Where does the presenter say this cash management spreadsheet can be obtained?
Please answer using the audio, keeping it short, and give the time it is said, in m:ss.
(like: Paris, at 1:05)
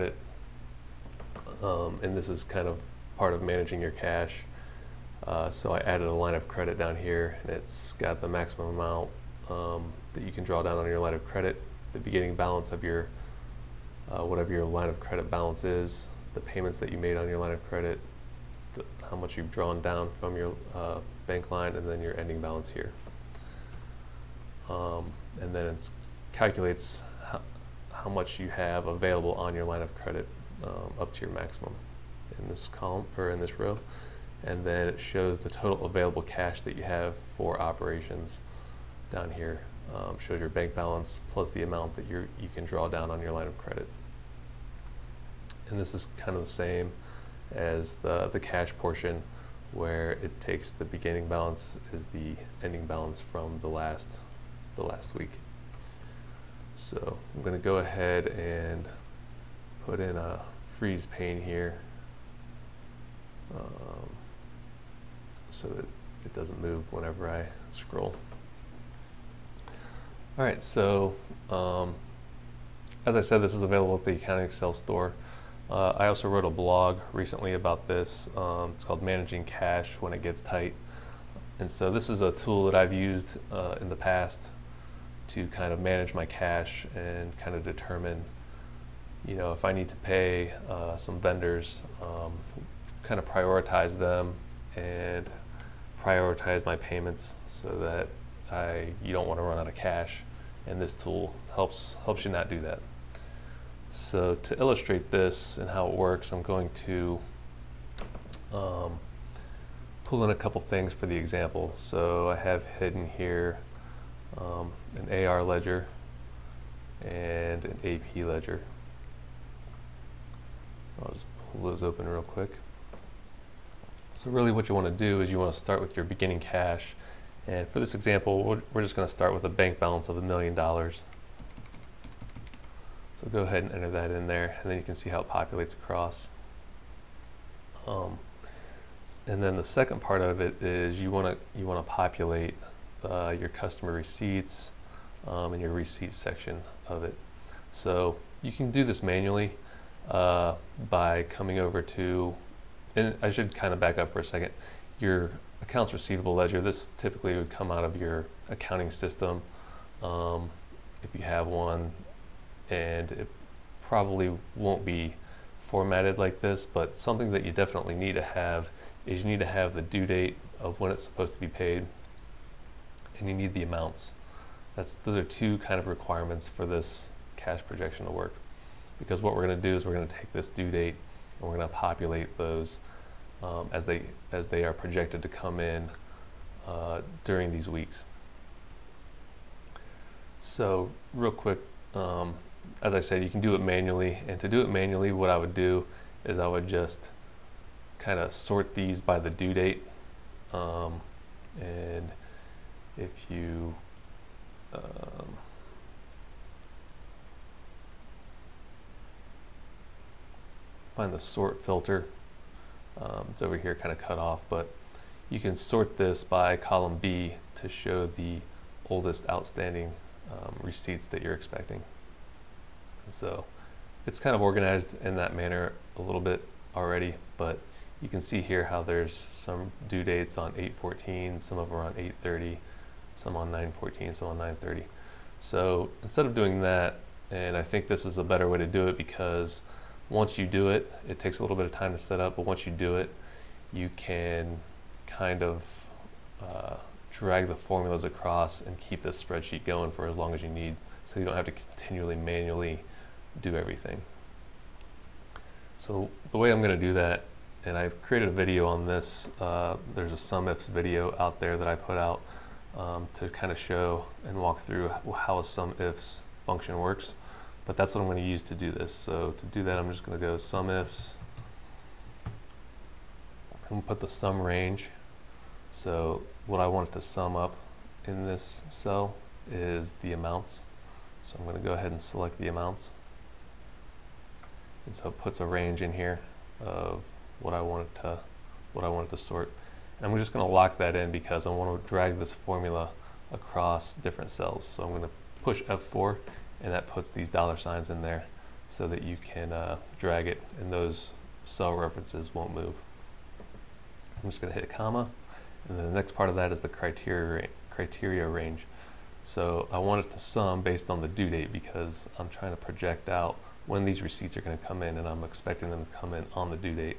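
AccountingExL store, at 1:14.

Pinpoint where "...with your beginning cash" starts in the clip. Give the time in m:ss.
2:05.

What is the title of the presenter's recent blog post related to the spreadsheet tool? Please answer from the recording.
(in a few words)
Managing Cash When It Gets Tight.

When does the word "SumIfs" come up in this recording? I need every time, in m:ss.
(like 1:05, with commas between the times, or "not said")
4:20, 4:25, 4:30.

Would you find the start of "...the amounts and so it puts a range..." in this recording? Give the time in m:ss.
4:42.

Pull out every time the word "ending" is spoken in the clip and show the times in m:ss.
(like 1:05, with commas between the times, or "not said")
0:22, 0:52.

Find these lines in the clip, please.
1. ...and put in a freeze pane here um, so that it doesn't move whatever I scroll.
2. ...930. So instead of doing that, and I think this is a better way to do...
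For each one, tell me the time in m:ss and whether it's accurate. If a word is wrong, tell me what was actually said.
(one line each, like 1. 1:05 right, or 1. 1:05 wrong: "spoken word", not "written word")
1. 0:58 wrong: "whenever", not "whatever"
2. 3:54 right.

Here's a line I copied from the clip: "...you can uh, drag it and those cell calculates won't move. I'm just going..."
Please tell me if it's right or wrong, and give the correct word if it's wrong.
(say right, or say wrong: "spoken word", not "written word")
wrong: "references", not "calculates".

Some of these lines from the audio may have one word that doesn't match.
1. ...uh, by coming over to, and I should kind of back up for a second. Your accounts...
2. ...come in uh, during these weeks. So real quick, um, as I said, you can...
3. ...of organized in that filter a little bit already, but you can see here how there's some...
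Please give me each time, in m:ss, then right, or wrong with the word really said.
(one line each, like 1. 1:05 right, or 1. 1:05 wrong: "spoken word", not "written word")
1. 2:30 right
2. 3:05 right
3. 3:44 wrong: "manner", not "filter".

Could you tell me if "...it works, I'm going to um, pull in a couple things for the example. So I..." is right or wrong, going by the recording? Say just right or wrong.
right.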